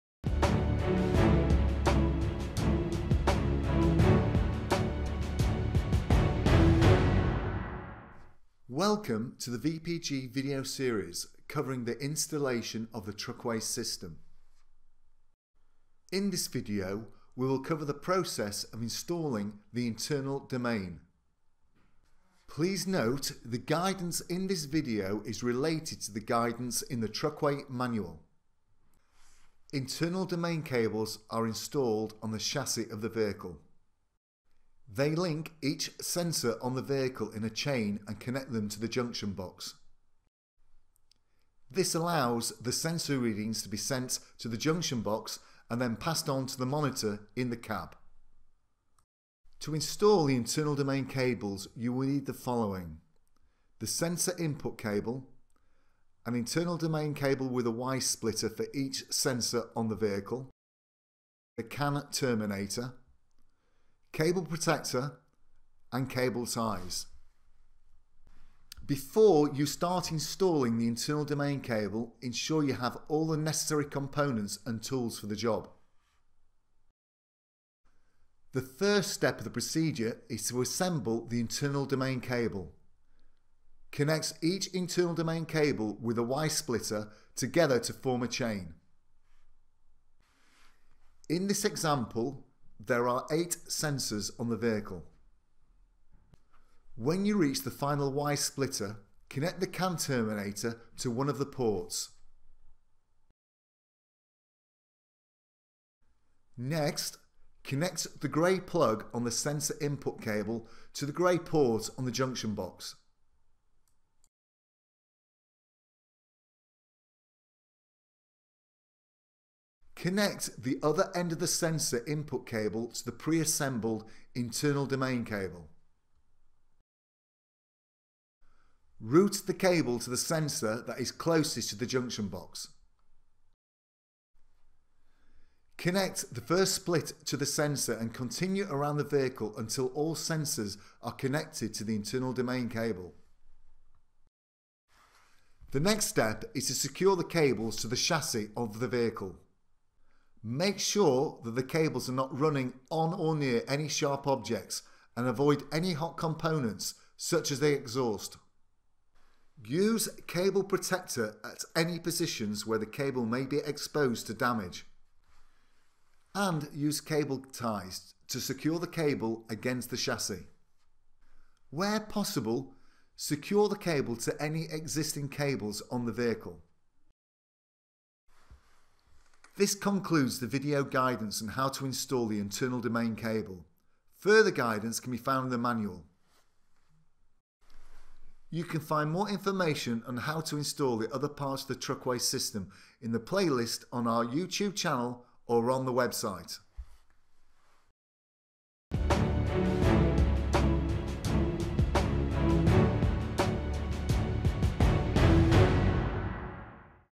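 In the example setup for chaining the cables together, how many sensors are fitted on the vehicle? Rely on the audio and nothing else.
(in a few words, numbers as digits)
8.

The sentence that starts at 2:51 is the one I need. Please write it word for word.
Where possible, secure the cable to any existing cables on the vehicle.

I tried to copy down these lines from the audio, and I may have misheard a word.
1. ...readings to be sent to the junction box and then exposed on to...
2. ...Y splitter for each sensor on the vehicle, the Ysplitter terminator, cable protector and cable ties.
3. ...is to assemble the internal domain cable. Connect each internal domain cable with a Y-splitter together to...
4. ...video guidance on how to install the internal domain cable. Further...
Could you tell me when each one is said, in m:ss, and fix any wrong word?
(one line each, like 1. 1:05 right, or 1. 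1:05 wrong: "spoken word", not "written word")
1. 0:43 wrong: "passed", not "exposed"
2. 0:57 wrong: "CAN", not "Ysplitter"
3. 1:20 right
4. 3:00 right.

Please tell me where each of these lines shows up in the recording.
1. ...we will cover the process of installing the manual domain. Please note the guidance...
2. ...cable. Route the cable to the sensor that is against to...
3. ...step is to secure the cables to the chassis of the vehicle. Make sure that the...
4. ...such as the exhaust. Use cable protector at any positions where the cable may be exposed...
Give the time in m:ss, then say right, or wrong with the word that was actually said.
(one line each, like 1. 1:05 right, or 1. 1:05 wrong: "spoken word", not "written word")
1. 0:17 wrong: "internal", not "manual"
2. 2:05 wrong: "closest", not "against"
3. 2:26 right
4. 2:37 right.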